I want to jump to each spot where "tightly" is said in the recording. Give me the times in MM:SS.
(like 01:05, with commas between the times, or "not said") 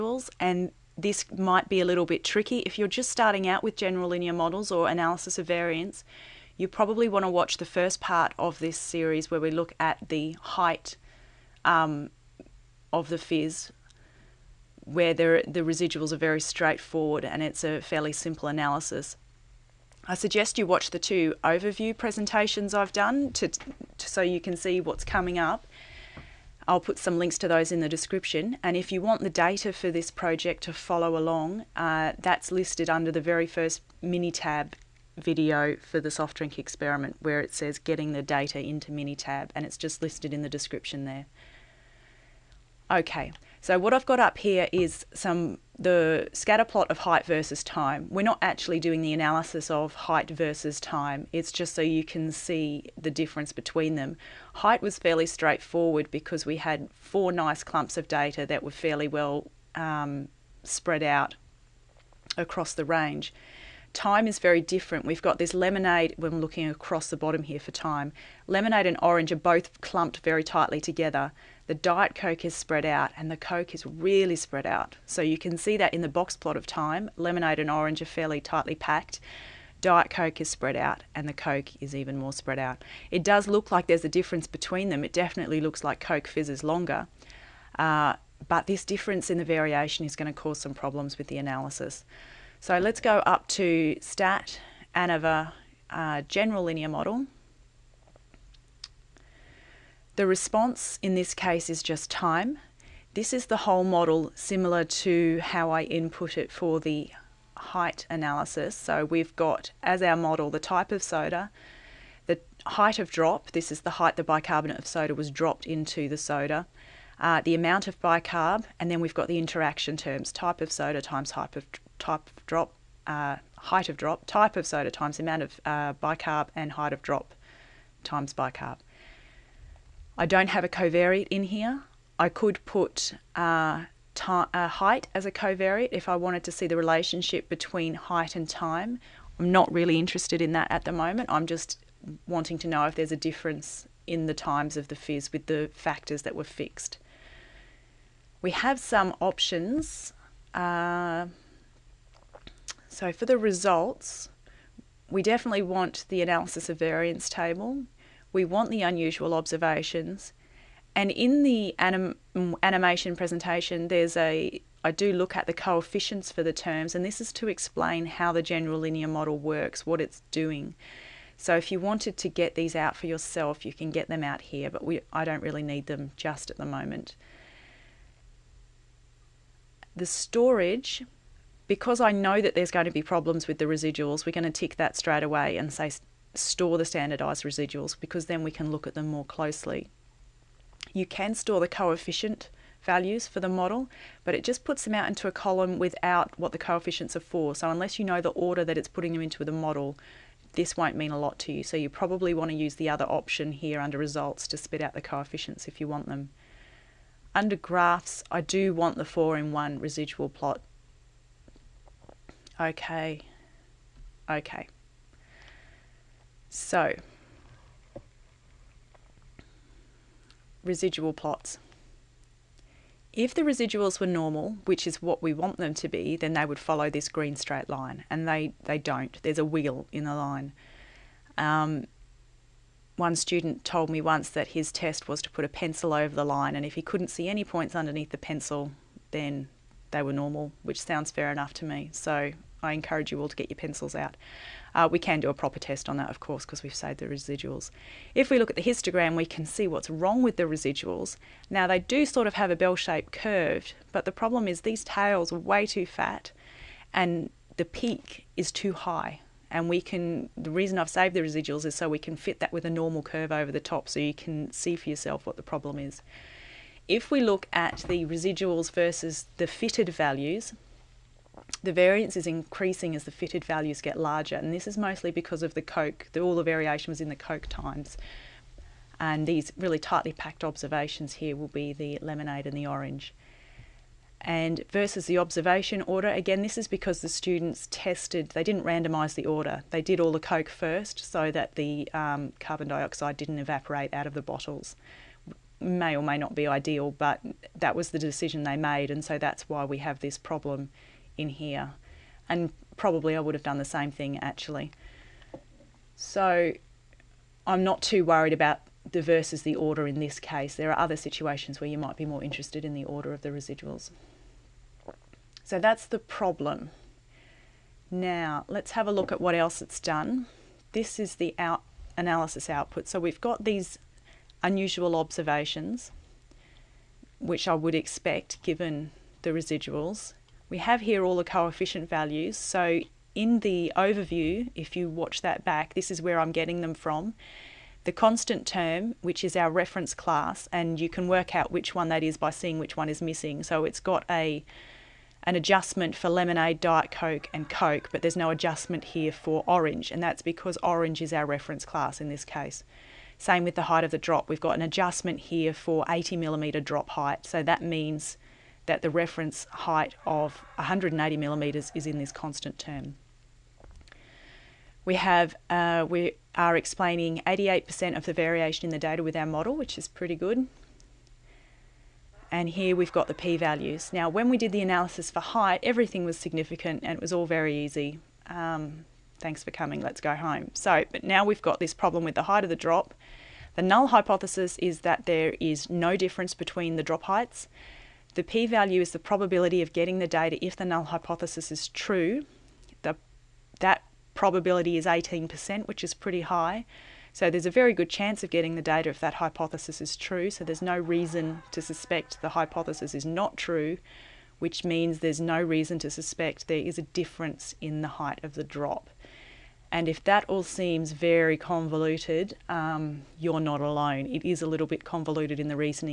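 01:10, 01:18, 04:39.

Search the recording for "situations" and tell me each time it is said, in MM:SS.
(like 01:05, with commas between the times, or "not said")
05:10.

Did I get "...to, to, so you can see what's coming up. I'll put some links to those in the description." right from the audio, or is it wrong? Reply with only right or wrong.
right.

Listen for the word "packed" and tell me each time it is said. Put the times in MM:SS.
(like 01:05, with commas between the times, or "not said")
01:18, 04:40.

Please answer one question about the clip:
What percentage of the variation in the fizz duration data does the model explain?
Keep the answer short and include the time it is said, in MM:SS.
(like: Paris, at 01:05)
88%, at 06:07.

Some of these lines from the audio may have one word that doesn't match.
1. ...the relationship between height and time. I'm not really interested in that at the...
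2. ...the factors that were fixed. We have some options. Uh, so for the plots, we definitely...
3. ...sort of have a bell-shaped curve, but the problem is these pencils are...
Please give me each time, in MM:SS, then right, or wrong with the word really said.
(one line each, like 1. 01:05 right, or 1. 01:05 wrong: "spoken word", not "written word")
1. 02:16 right
2. 02:25 wrong: "results", not "plots"
3. 04:12 wrong: "tails", not "pencils".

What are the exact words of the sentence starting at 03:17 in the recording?
So unless you know the order that it's putting them into the model, this won't mean a lot to you.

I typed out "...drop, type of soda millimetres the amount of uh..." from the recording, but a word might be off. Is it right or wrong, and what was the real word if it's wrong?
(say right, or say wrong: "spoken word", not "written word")
wrong: "times", not "millimetres".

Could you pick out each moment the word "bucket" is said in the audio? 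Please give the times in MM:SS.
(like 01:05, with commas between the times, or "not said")
not said.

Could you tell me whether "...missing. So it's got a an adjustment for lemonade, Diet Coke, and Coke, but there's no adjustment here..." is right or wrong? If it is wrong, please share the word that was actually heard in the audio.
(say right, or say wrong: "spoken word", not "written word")
right.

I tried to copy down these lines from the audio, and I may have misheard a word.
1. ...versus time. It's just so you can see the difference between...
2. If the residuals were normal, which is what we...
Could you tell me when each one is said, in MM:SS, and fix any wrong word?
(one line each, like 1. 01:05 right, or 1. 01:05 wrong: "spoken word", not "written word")
1. 00:50 right
2. 03:43 right.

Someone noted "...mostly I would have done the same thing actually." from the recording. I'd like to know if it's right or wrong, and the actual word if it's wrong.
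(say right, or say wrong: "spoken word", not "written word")
wrong: "probably", not "mostly".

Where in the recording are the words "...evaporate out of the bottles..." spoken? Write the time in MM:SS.
04:53.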